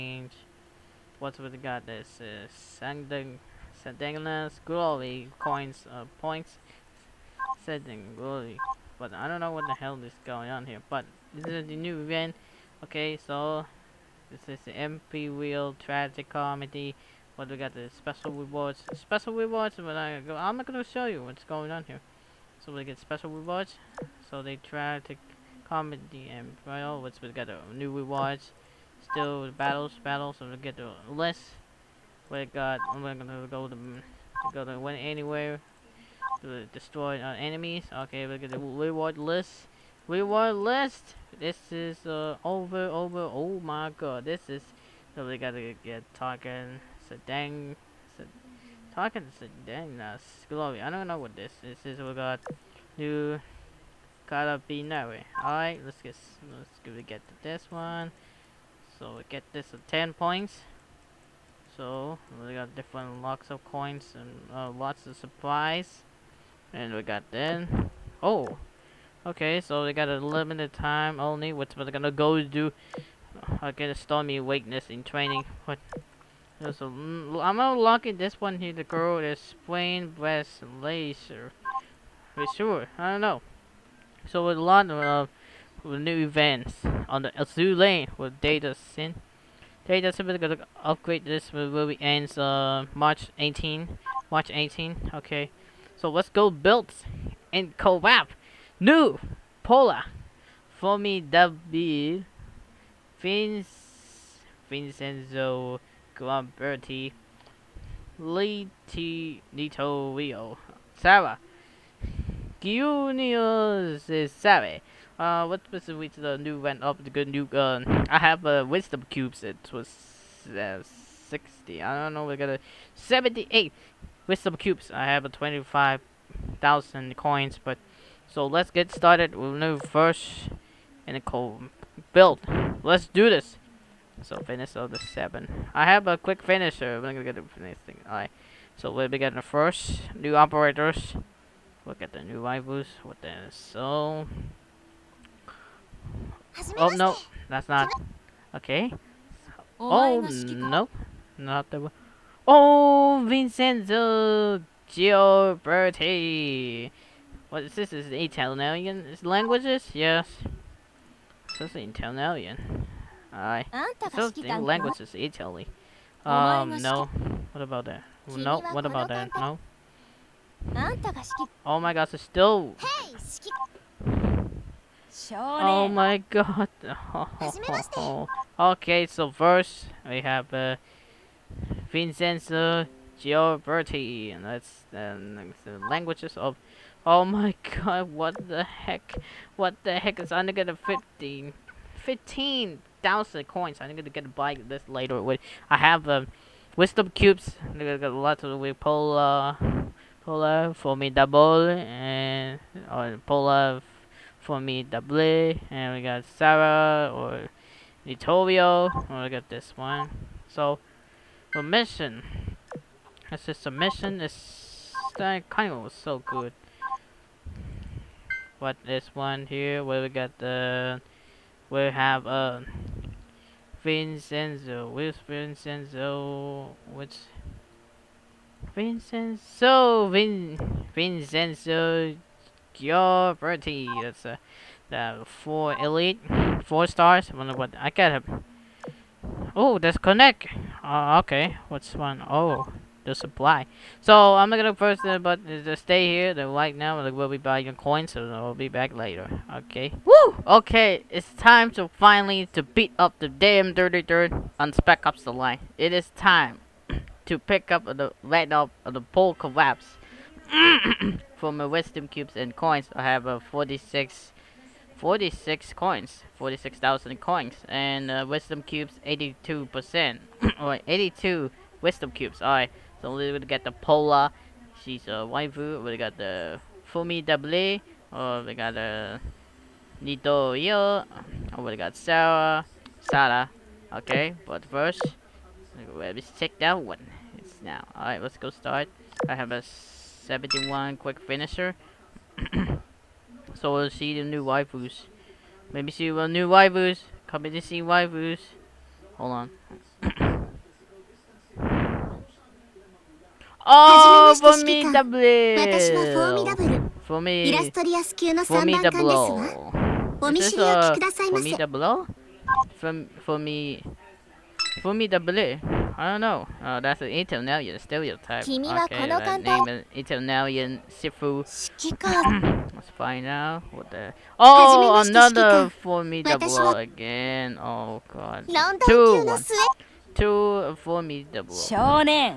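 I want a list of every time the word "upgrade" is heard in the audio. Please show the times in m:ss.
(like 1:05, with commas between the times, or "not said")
1:30.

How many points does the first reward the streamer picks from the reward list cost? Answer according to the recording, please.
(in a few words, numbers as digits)
10 points.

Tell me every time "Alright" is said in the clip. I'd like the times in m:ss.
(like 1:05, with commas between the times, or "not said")
0:55, 2:18, 4:32, 4:47.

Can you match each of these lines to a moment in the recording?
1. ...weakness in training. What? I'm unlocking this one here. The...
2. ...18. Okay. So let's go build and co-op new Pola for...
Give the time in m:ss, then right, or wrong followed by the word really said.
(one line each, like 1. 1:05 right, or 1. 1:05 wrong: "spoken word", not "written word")
1. 1:14 right
2. 1:34 right.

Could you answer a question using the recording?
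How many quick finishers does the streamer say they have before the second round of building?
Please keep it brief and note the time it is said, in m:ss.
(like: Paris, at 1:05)
71, at 4:49.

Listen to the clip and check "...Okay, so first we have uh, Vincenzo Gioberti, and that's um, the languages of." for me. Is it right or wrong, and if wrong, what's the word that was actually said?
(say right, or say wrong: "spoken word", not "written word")
right.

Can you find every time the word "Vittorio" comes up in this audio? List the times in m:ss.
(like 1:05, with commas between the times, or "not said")
3:28.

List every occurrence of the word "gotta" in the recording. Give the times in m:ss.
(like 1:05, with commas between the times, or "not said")
0:45.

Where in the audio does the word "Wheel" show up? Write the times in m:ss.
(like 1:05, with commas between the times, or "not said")
0:15.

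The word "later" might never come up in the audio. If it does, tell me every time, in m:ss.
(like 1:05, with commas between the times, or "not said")
3:14, 4:08.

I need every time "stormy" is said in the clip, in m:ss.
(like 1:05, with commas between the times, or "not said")
1:13.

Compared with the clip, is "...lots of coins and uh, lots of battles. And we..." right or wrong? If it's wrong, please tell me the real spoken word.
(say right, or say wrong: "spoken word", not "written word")
wrong: "supplies", not "battles".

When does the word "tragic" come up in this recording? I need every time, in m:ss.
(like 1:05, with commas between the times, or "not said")
0:15, 0:24.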